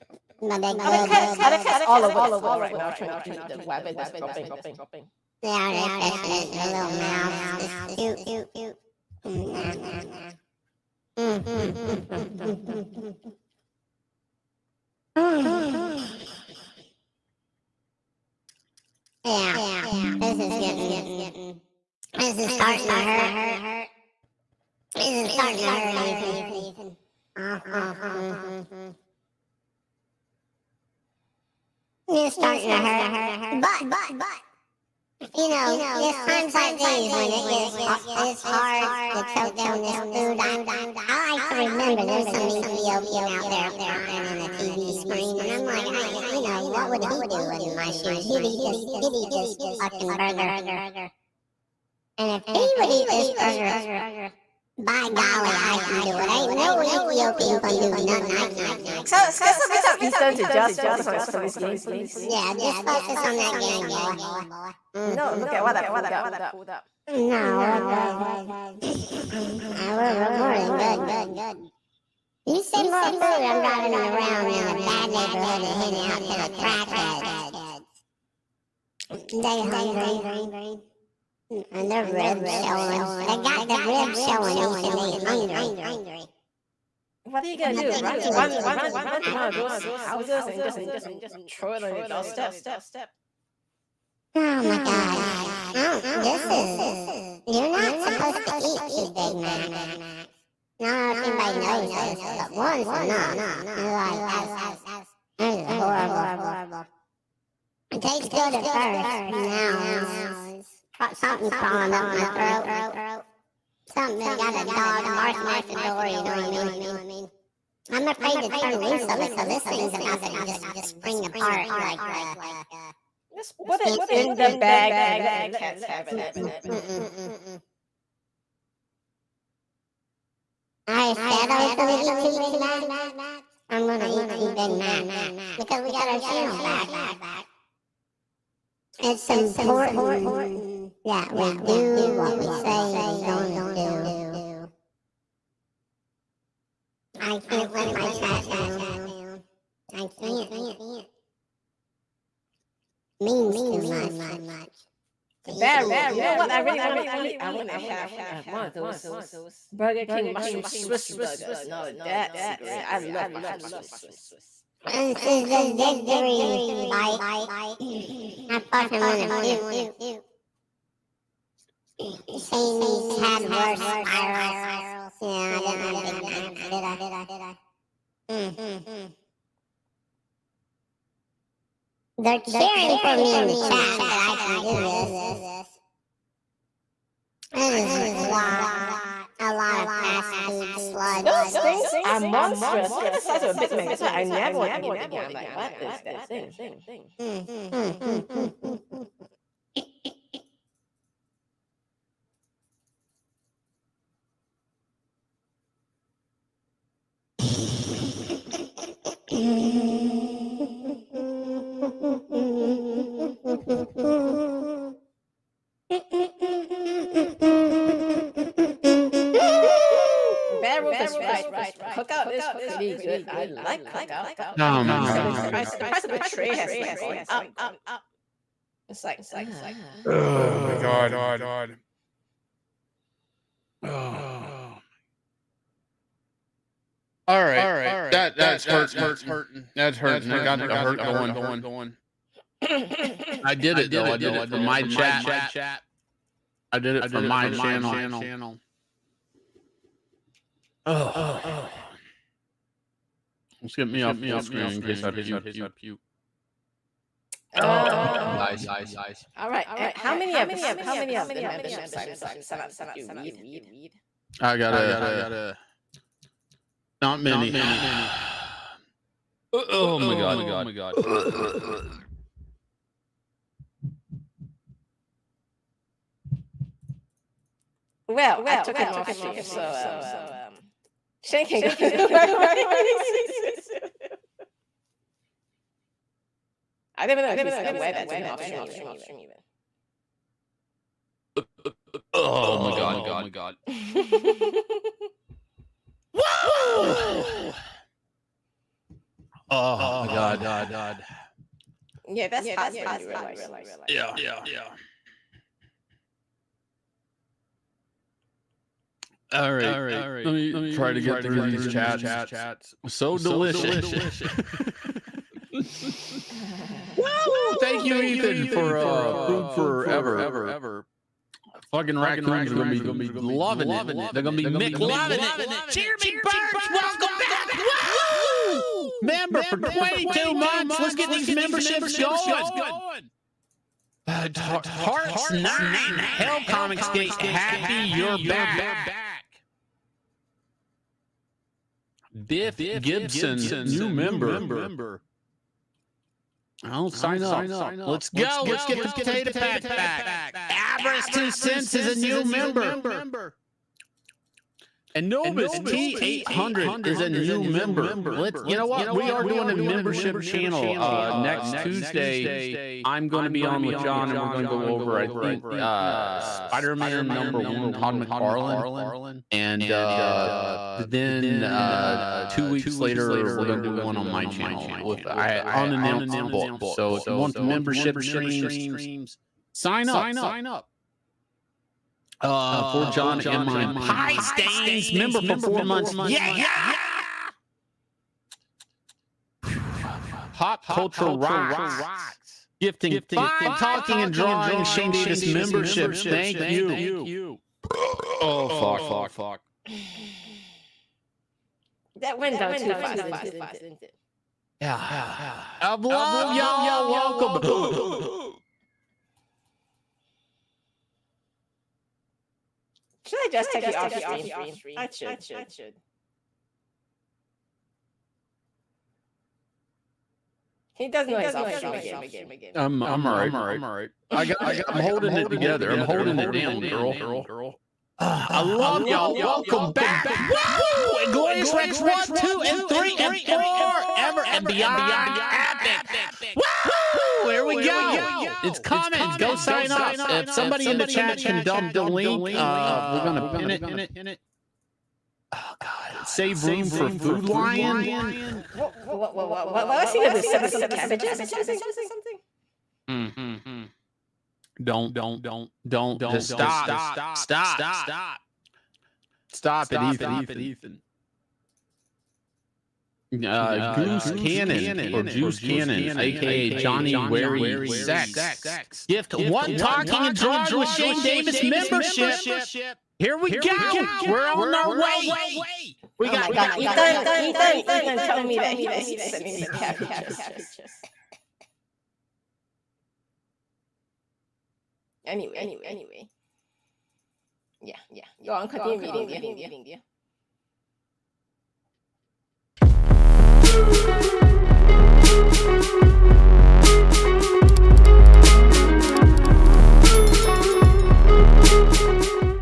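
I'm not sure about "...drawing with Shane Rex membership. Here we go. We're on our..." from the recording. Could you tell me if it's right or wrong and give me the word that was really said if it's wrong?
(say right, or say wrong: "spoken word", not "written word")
wrong: "Davis", not "Rex".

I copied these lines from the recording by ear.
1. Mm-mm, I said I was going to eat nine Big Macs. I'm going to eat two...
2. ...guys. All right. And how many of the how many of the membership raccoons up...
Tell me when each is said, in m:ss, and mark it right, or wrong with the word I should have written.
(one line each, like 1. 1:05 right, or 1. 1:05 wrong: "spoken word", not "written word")
1. 2:06 wrong: "two", not "nine"
2. 4:18 wrong: "signs", not "raccoons".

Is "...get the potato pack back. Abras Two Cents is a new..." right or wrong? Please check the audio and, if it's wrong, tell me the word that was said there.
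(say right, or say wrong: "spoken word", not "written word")
right.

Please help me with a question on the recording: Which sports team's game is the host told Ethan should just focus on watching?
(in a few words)
Phillies.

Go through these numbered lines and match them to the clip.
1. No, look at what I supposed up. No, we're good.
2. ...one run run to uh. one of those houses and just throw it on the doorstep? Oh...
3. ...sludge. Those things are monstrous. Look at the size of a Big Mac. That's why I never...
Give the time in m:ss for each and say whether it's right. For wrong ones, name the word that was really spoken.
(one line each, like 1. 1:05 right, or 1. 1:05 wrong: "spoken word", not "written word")
1. 1:05 wrong: "pulled", not "supposed"
2. 1:28 right
3. 3:10 right.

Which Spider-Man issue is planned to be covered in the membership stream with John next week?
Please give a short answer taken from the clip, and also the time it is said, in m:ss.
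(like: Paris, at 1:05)
Spider-Man number 1, at 6:06.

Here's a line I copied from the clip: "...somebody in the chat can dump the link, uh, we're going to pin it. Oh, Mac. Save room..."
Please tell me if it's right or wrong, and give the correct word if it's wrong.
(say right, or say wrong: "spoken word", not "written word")
wrong: "God", not "Mac".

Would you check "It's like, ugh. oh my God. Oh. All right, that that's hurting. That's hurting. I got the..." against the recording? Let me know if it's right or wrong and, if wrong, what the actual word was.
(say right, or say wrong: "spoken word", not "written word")
right.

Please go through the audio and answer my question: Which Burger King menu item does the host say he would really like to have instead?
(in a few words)
mushroom Swiss burgers.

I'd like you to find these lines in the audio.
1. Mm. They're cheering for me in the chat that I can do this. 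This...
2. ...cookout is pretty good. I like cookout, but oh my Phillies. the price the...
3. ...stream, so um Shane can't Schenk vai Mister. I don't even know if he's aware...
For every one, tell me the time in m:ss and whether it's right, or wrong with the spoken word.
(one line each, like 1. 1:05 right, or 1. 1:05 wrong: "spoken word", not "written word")
1. 2:58 right
2. 3:41 wrong: "God", not "Phillies"
3. 4:39 right.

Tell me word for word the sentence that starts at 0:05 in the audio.
Yeah, they're catching it in their little mouths.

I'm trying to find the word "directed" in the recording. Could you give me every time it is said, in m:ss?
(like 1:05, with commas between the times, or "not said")
not said.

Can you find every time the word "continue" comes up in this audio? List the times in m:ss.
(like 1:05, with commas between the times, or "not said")
8:08.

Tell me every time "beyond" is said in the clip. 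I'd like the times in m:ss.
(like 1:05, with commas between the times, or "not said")
7:14.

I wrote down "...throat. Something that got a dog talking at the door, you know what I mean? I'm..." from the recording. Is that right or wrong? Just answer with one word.
wrong.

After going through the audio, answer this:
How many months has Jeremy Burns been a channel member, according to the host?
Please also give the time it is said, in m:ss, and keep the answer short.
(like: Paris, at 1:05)
22, at 5:29.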